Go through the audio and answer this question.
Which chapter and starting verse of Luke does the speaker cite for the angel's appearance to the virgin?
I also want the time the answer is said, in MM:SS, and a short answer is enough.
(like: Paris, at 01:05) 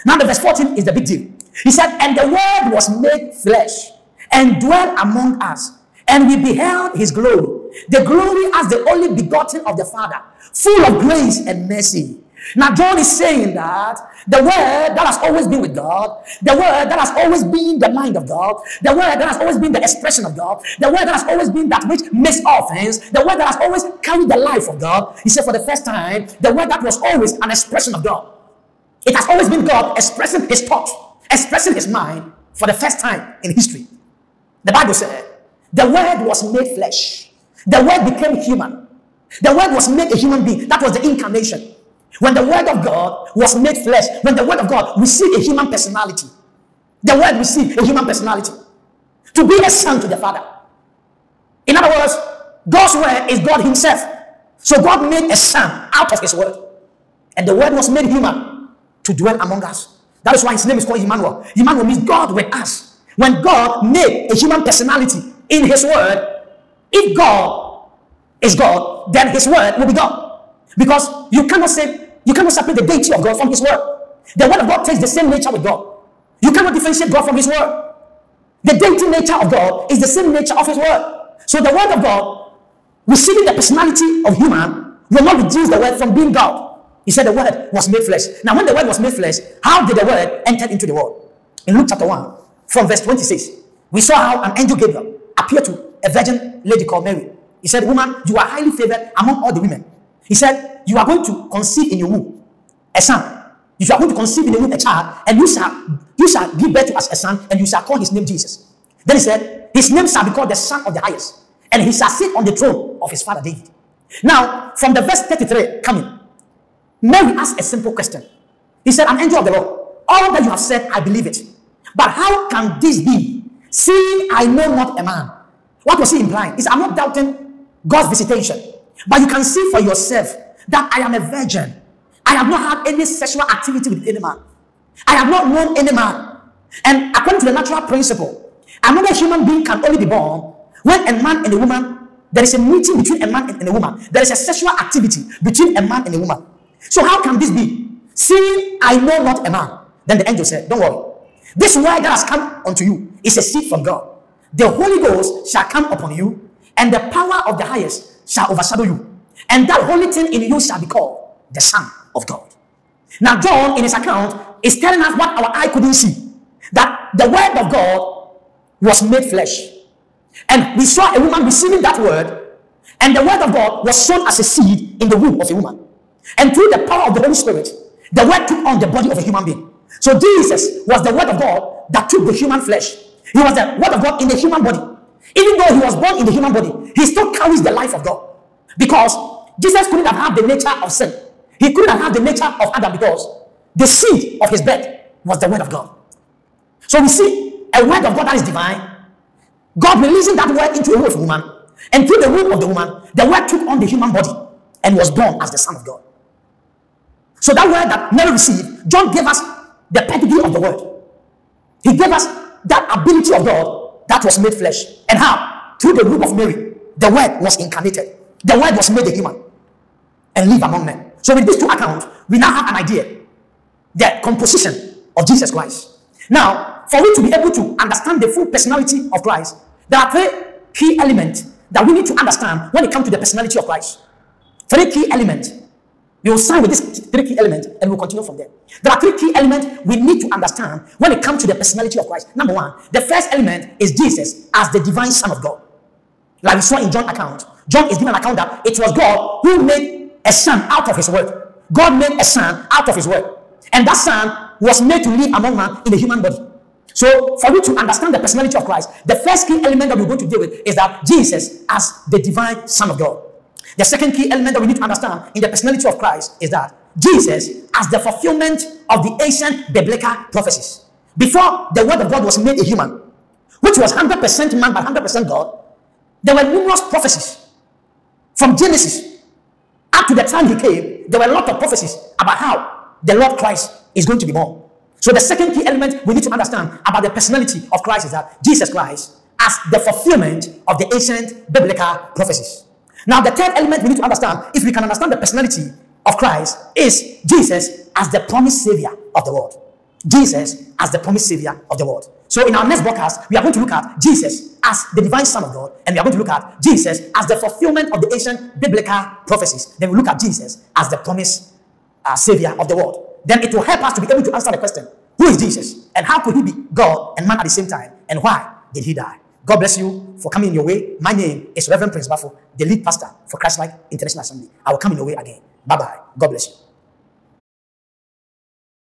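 Chapter 1, verse 26, at 01:31.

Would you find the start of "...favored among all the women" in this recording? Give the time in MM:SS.
01:38.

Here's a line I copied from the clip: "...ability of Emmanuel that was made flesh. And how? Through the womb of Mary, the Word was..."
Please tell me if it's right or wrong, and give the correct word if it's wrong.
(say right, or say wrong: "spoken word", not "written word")
wrong: "God", not "Emmanuel".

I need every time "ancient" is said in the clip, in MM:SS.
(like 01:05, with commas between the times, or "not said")
04:29, 04:50, 05:08.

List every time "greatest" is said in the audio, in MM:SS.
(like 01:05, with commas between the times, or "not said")
not said.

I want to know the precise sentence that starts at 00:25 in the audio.
He said, for the first time, the word that was always an expression of God.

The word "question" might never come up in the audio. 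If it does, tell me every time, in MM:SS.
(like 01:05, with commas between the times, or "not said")
01:57, 05:14.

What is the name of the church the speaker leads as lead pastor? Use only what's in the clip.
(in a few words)
Christlike International Assembly.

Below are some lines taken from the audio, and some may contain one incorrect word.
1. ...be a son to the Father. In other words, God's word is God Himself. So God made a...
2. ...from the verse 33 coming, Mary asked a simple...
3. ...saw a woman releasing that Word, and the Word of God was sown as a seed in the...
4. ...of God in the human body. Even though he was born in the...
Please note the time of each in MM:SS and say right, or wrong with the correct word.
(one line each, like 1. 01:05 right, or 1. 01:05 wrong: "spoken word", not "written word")
1. 00:49 right
2. 01:54 right
3. 02:50 wrong: "receiving", not "releasing"
4. 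03:03 right.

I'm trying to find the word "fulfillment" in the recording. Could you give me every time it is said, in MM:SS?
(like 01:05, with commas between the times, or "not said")
04:27, 04:49, 05:07.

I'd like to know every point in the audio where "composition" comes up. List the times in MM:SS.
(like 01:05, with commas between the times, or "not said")
03:44.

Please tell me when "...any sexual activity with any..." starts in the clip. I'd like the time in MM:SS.
02:12.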